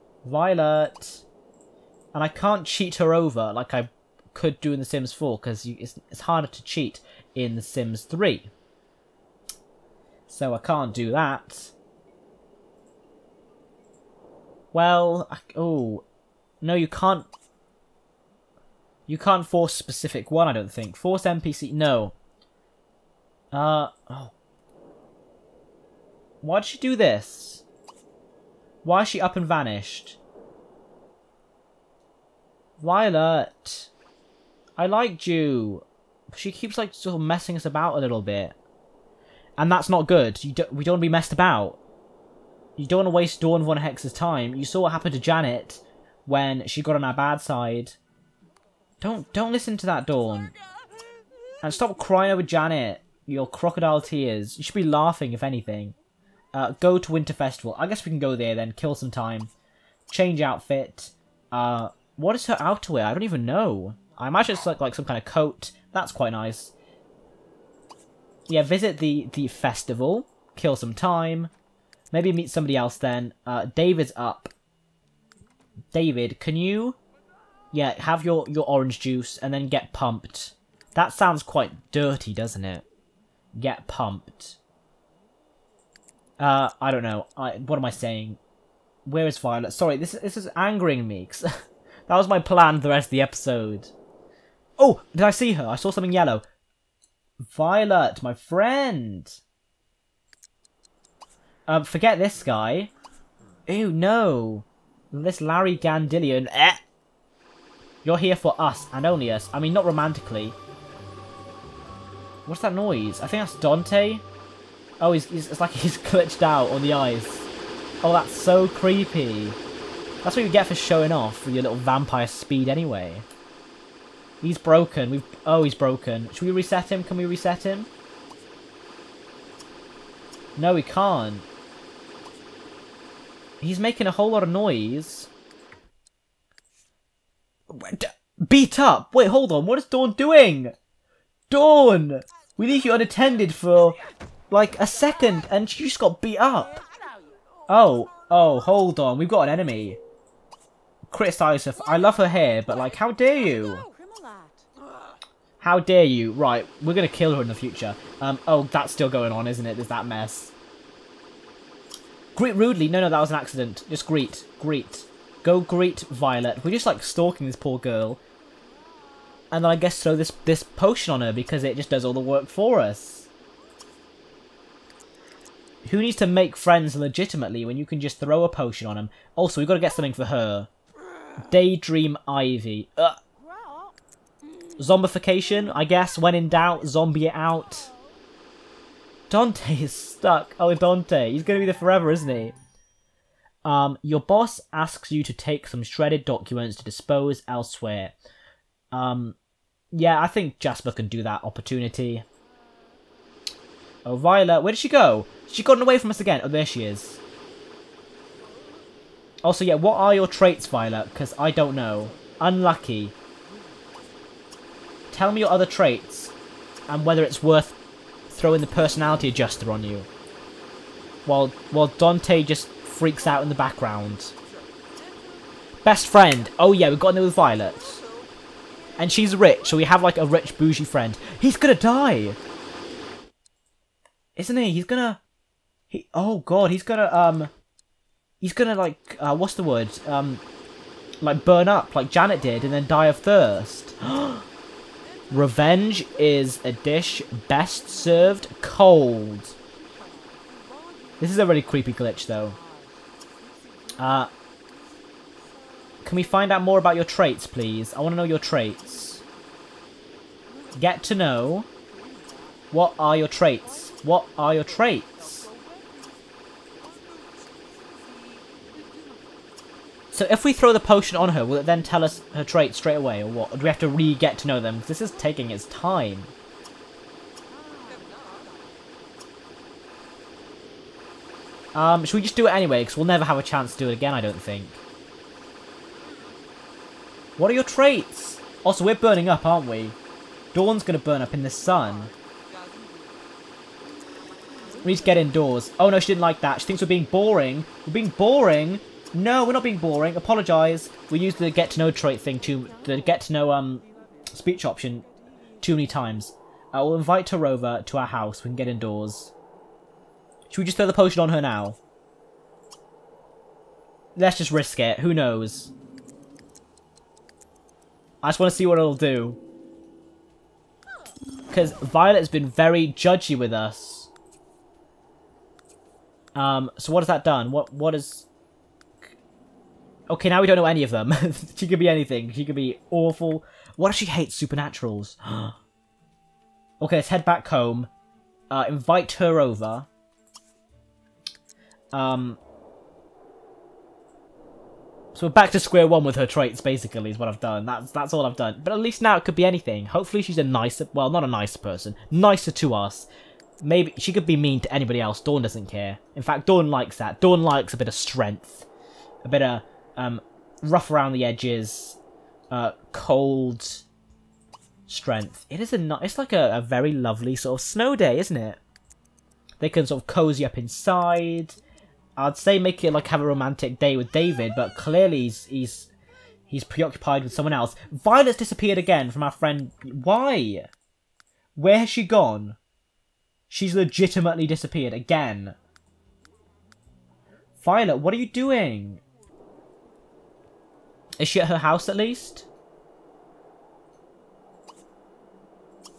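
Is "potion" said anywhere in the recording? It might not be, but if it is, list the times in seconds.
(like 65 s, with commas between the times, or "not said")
170 s, 178 s, 270 s, 310 s.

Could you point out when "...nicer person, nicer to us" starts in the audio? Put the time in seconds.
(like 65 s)
351 s.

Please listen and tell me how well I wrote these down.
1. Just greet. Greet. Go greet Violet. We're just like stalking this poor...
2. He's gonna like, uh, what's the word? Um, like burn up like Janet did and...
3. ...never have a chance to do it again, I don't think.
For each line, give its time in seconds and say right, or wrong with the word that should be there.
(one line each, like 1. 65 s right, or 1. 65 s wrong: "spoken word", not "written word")
1. 163 s right
2. 238 s right
3. 283 s right.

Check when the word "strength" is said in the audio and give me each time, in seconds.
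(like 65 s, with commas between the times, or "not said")
357 s, 364 s.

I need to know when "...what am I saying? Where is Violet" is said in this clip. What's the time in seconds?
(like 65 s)
87 s.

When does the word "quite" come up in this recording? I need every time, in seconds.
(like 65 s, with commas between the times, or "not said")
66 s, 81 s.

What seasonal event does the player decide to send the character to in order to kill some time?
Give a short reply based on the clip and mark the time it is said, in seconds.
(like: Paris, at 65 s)
Winter Festival, at 57 s.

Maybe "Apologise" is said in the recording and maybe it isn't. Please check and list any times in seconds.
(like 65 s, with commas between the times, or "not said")
300 s.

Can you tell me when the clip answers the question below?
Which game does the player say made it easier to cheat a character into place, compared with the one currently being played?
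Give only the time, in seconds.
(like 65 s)
4 s.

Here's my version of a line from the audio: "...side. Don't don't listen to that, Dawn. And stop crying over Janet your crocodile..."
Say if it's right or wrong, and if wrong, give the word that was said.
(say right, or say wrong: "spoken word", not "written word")
right.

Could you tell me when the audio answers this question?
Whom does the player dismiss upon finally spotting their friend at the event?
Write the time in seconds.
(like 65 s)
105 s.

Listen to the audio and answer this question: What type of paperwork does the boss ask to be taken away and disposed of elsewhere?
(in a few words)
Shredded documents.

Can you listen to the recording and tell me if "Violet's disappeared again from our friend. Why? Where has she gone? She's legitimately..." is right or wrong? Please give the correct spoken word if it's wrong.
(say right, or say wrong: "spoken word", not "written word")
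right.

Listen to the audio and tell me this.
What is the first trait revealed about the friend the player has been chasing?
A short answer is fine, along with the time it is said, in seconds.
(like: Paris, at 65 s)
Unlucky, at 212 s.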